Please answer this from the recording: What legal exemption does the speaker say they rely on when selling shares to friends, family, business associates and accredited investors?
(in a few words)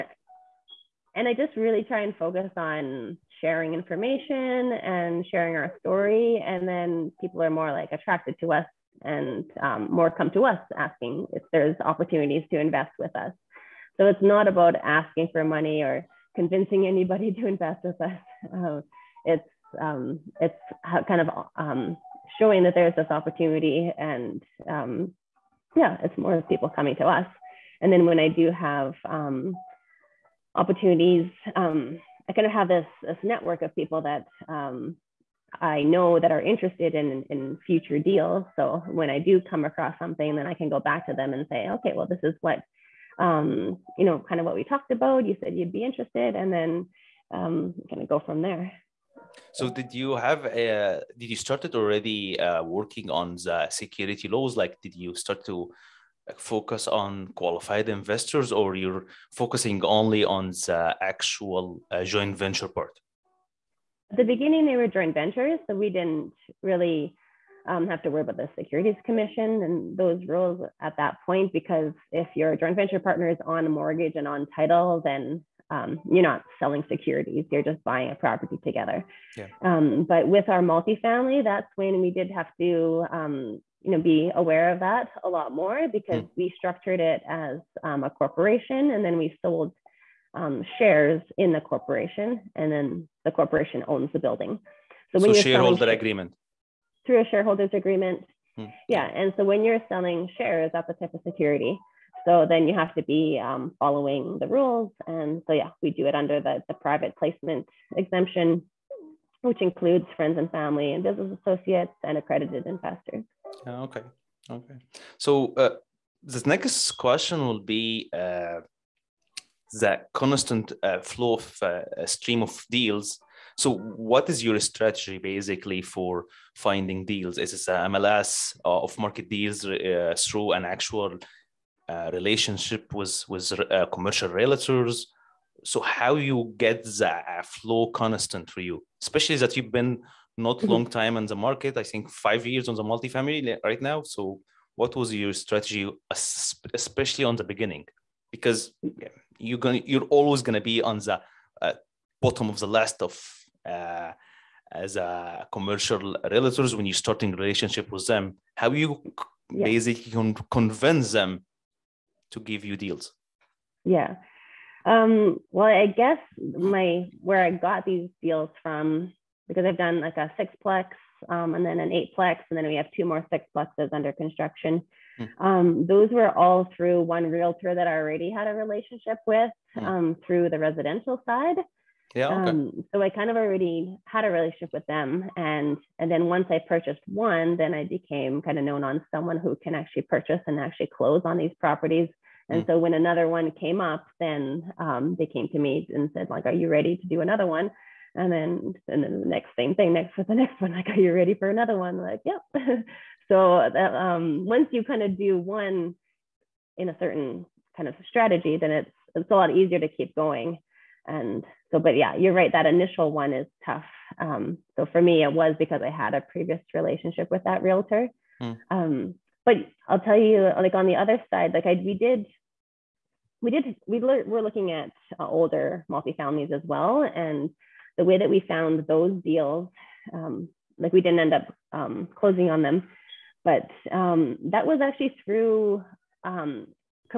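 private placement exemption.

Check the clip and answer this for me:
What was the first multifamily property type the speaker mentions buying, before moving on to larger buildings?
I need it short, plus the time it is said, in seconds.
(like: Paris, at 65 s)
sixplex, at 170 s.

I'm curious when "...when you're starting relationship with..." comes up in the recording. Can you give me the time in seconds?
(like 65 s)
156 s.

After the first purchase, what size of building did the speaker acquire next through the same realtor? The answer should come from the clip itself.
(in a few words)
eightplex.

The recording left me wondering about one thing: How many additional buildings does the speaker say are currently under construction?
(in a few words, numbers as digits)
2.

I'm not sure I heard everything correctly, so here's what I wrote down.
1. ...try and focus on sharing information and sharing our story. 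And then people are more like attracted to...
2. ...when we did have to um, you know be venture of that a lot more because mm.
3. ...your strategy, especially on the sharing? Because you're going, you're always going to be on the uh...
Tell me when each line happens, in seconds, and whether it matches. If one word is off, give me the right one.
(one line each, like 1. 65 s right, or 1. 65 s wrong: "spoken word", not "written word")
1. 1 s right
2. 81 s wrong: "aware", not "venture"
3. 145 s wrong: "beginning", not "sharing".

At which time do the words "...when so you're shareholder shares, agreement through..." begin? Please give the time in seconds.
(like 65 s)
95 s.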